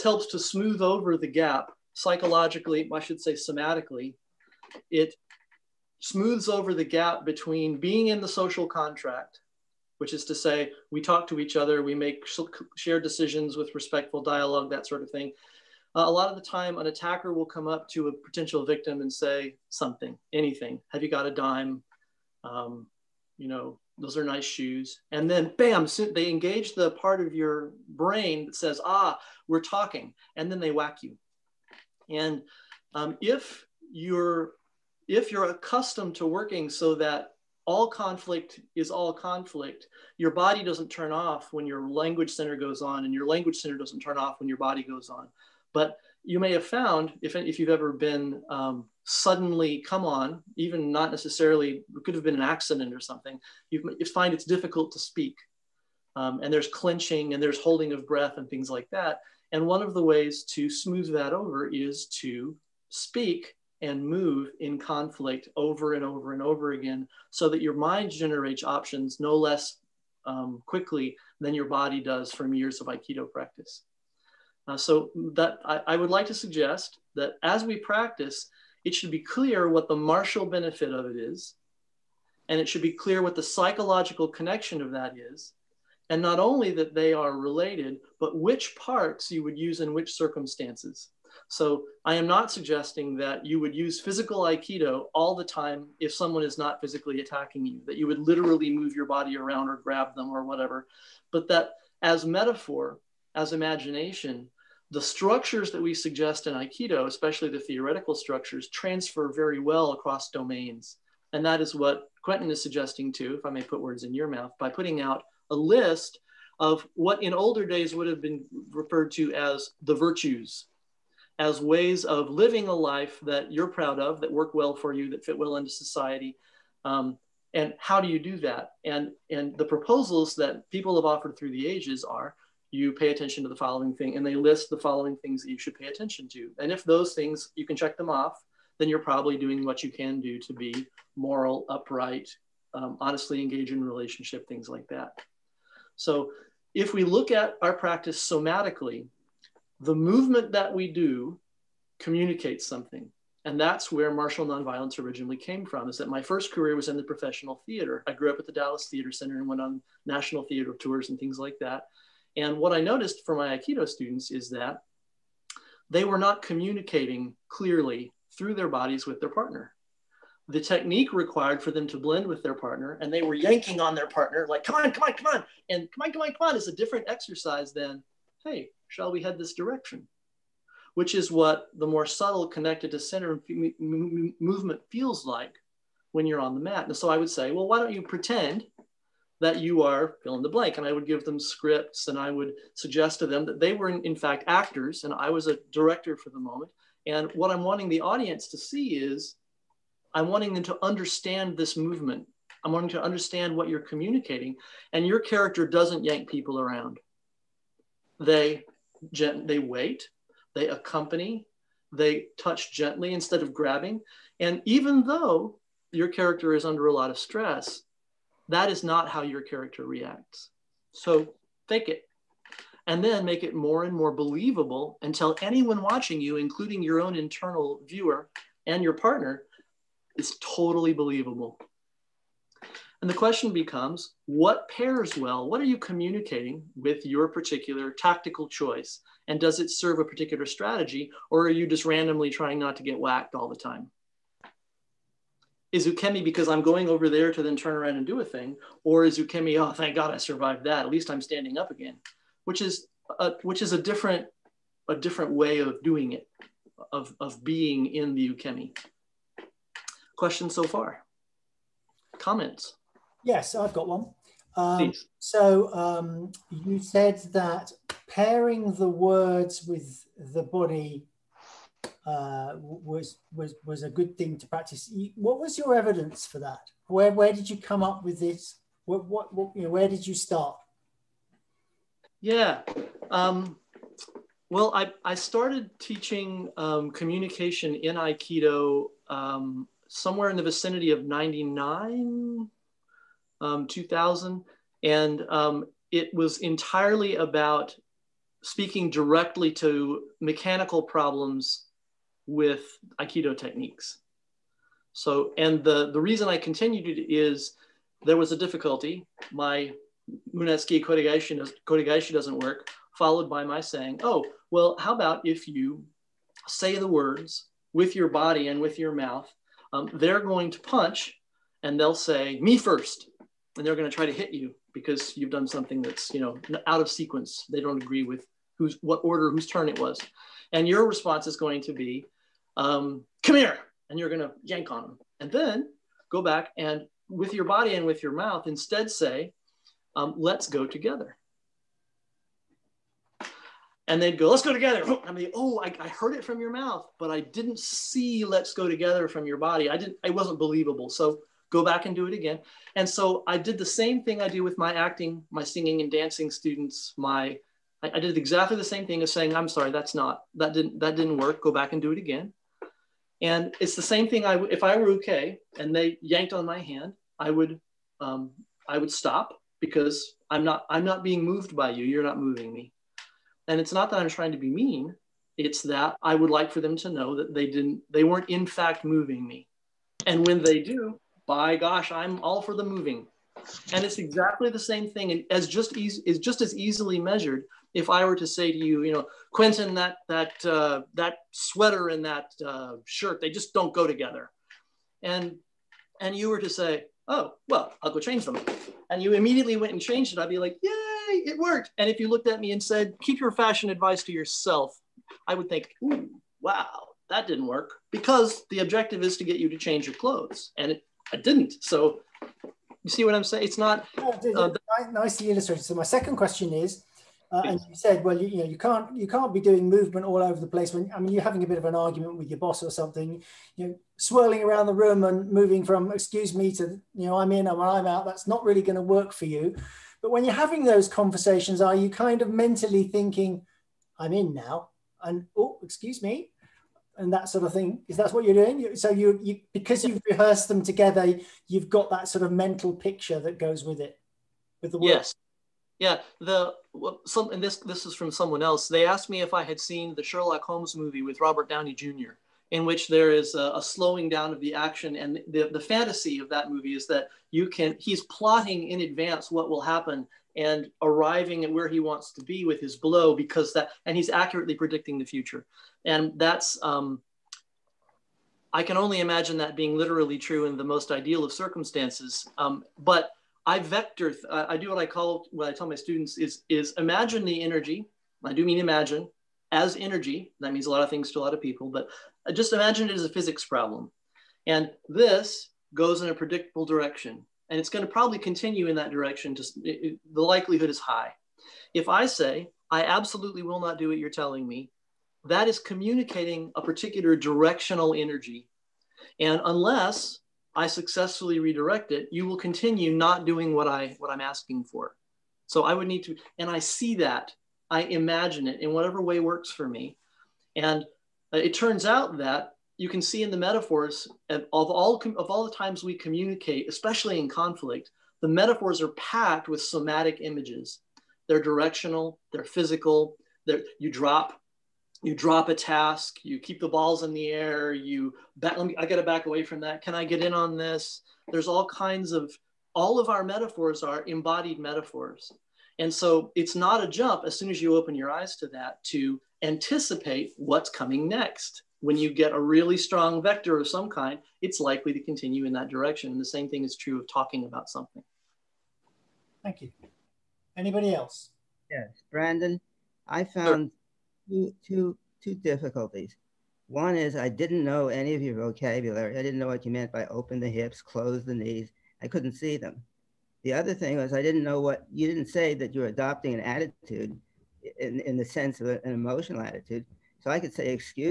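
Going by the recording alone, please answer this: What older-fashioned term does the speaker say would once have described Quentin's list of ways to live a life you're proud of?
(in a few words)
virtues.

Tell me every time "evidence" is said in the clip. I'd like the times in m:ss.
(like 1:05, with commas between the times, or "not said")
4:35.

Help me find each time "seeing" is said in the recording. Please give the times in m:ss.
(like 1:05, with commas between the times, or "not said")
not said.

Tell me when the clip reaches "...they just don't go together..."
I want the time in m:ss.
6:33.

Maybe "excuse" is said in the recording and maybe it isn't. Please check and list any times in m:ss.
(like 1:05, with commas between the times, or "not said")
7:05, 7:15.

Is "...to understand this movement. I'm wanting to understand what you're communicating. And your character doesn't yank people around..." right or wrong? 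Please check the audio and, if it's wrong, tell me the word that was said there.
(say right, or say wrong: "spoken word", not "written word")
right.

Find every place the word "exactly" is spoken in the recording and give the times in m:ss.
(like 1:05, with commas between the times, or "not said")
5:58, 6:23.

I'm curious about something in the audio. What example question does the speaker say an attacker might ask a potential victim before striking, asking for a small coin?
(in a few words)
Have you got a dime?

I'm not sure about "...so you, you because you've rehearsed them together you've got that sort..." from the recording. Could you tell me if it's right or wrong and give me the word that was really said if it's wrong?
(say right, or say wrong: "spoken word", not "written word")
right.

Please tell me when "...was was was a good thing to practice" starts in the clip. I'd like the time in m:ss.
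4:32.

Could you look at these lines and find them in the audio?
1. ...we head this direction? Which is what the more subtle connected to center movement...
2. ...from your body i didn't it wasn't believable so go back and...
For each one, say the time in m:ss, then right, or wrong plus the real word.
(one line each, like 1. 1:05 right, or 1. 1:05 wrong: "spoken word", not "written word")
1. 2:59 right
2. 5:49 right.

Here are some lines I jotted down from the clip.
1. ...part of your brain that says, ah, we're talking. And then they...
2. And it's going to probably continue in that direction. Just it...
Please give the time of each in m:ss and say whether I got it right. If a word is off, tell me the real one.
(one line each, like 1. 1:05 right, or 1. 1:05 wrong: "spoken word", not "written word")
1. 0:26 right
2. 8:07 right.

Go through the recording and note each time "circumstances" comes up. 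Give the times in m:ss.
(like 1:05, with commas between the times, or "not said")
1:30, 7:51.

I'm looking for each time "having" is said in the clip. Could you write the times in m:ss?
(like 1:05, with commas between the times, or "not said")
7:01, 7:10.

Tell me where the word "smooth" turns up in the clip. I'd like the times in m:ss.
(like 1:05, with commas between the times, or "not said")
0:00, 0:06, 1:00.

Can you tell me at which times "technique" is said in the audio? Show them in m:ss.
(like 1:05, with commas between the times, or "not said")
2:50, 5:03.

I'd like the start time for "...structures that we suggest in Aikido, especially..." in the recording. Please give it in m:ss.
1:45.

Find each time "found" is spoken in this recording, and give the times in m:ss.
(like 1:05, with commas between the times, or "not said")
0:46, 9:13.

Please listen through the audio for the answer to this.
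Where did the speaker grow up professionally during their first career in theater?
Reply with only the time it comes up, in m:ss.
2:38.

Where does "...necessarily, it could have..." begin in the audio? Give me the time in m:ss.
0:51.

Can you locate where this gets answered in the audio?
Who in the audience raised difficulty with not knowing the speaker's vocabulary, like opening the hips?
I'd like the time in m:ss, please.
9:12.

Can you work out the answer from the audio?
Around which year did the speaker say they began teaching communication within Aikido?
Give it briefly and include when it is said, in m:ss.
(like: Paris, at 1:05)
2000, at 4:53.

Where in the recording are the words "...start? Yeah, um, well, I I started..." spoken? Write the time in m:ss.
4:40.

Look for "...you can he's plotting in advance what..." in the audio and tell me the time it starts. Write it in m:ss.
7:37.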